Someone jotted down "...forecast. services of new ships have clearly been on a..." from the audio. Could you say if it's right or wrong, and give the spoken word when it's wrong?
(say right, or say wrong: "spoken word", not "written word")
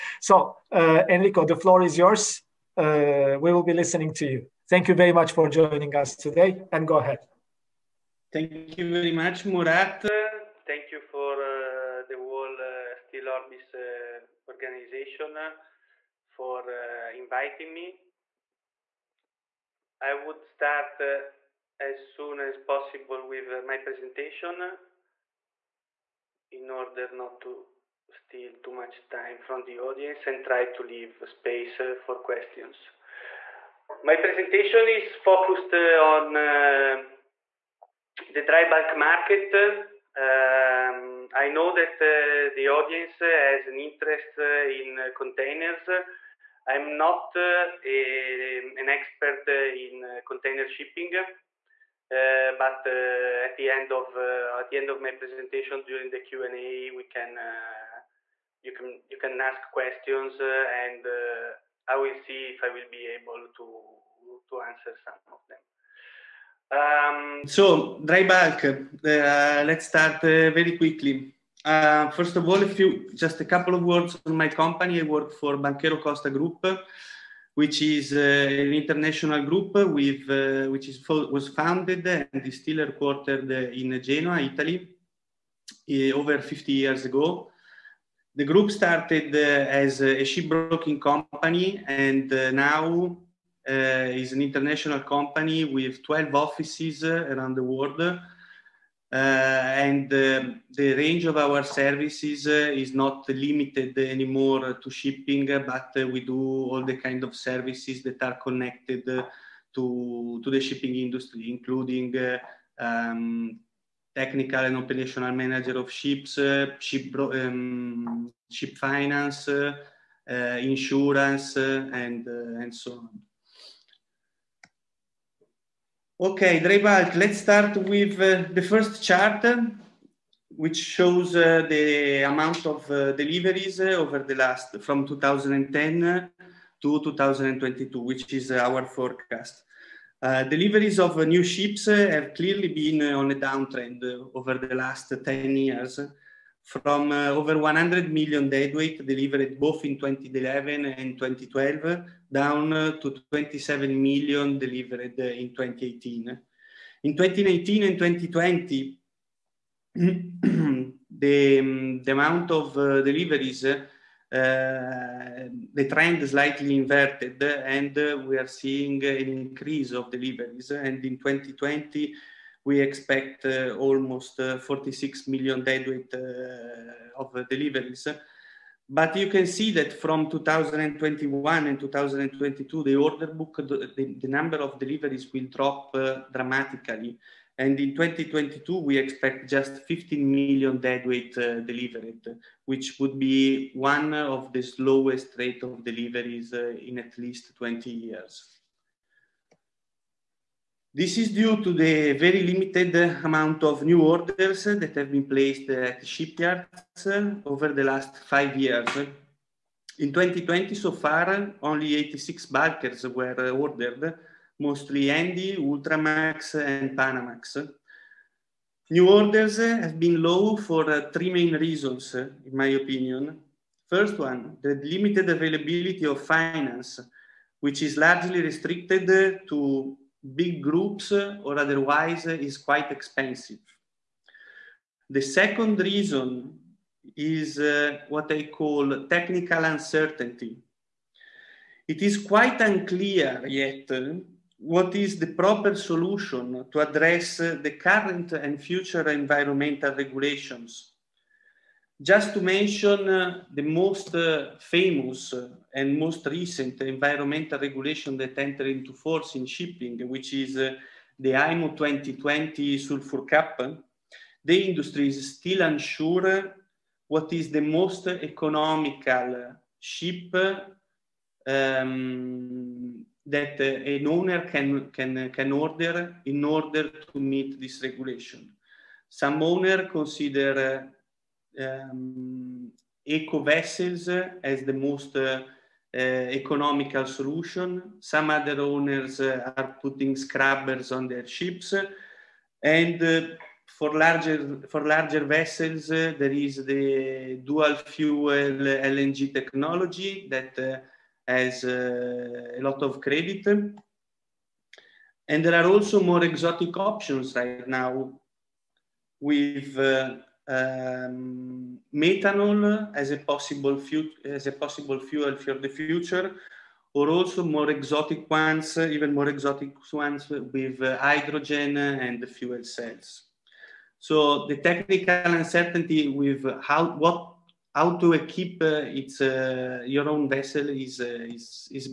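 wrong: "deliveries", not "services".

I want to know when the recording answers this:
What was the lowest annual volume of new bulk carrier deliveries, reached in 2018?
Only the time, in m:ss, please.
2:33.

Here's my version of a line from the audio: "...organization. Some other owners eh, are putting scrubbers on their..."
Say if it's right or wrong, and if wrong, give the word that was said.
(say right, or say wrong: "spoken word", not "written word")
wrong: "solution", not "organization".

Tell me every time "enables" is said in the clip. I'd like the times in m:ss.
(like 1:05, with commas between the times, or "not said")
not said.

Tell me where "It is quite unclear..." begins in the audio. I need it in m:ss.
4:01.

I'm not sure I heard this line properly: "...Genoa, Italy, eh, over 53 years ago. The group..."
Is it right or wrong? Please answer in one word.
wrong.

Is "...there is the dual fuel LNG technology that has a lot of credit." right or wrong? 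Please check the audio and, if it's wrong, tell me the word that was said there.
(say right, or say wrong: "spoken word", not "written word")
right.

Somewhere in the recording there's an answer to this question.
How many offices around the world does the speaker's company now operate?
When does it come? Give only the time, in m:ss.
1:36.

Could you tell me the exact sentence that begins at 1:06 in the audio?
Um, so dry bulk, uh, let's start uh, very quickly.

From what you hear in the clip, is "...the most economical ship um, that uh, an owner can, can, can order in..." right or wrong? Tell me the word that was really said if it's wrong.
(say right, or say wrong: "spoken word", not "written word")
right.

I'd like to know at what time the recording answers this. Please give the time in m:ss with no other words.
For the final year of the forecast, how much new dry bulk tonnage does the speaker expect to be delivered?
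3:09.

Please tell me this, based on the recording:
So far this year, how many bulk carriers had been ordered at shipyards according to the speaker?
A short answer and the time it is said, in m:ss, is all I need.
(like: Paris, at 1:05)
86, at 3:31.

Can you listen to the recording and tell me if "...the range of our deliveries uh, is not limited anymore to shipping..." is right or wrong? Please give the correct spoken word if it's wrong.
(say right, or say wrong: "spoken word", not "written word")
wrong: "services", not "deliveries".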